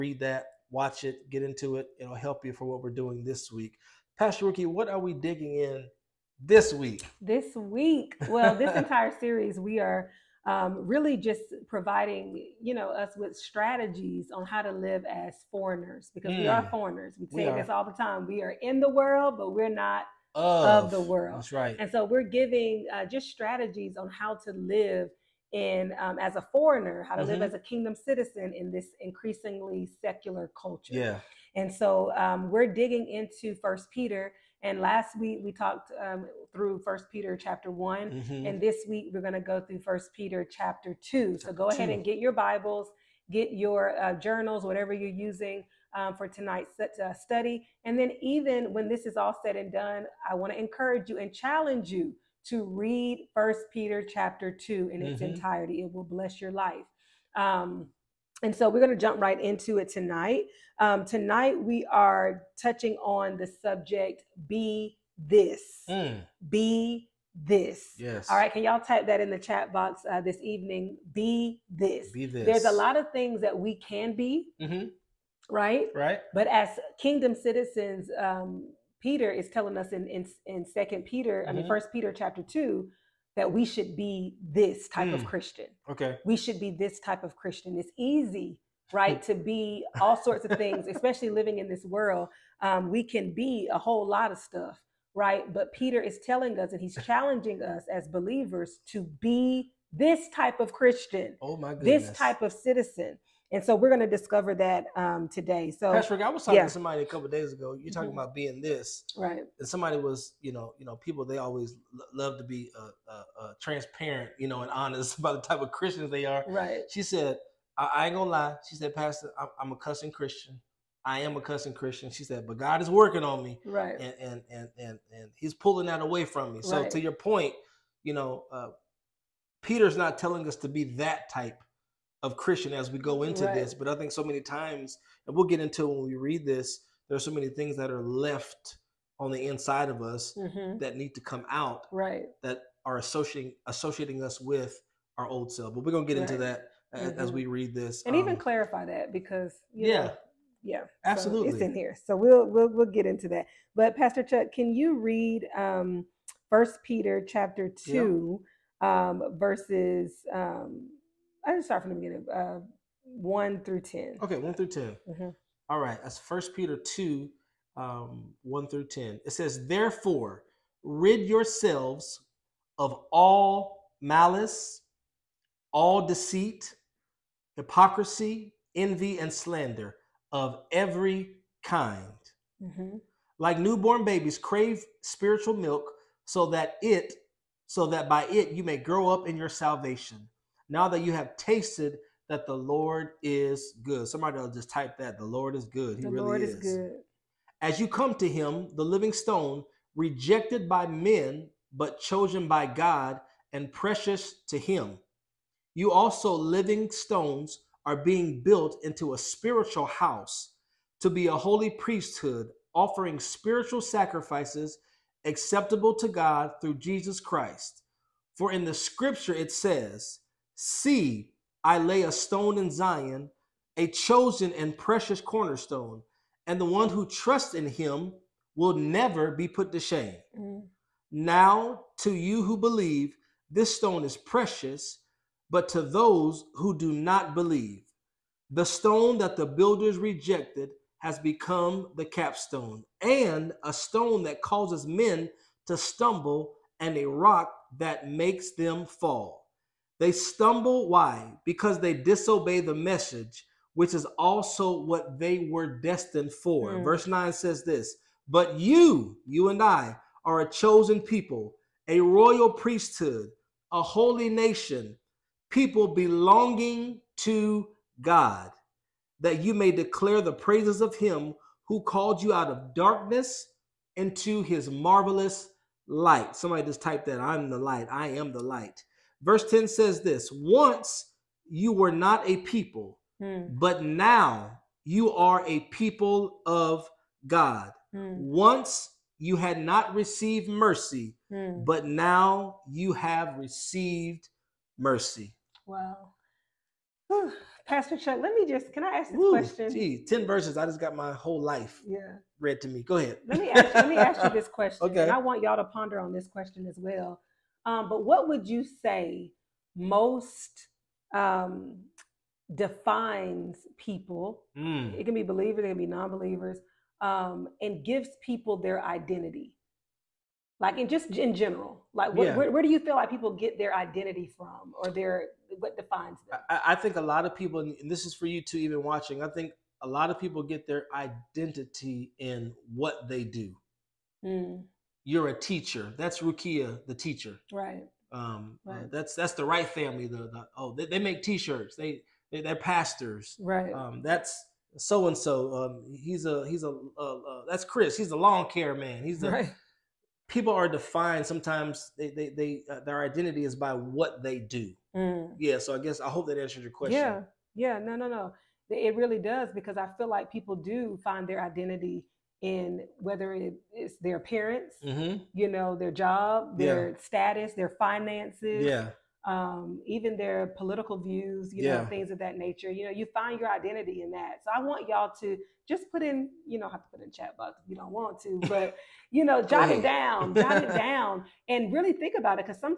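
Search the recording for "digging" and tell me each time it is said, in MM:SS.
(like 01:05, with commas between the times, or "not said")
00:05, 00:32.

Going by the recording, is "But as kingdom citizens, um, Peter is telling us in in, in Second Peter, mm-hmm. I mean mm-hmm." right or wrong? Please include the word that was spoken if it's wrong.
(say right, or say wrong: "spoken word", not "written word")
right.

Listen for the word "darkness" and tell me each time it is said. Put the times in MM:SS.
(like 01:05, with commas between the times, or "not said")
04:32.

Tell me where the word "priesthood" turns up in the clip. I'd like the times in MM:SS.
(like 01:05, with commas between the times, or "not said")
03:31, 04:22.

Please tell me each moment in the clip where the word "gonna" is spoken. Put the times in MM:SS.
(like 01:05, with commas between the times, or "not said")
01:58, 02:25.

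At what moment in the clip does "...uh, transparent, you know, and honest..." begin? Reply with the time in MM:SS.
01:53.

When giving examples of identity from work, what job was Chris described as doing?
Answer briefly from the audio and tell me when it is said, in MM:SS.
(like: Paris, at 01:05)
lawn care, at 05:48.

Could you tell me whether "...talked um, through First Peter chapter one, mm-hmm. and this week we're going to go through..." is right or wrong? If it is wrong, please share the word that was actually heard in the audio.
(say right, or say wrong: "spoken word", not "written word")
right.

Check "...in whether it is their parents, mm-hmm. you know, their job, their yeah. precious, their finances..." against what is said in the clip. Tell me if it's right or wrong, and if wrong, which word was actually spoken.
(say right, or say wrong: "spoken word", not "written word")
wrong: "status", not "precious".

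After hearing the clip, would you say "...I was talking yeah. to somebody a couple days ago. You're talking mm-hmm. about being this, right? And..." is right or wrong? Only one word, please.
right.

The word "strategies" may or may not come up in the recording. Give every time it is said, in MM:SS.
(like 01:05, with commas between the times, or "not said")
00:13, 00:23.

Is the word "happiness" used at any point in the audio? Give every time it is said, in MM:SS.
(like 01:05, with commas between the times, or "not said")
not said.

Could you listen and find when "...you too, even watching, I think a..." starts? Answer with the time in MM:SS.
05:28.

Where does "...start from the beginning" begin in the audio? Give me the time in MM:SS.
02:41.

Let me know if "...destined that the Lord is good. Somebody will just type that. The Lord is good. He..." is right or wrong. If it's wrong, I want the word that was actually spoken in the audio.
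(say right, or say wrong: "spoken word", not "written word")
wrong: "tasted", not "destined".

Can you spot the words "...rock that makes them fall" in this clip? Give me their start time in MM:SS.
04:07.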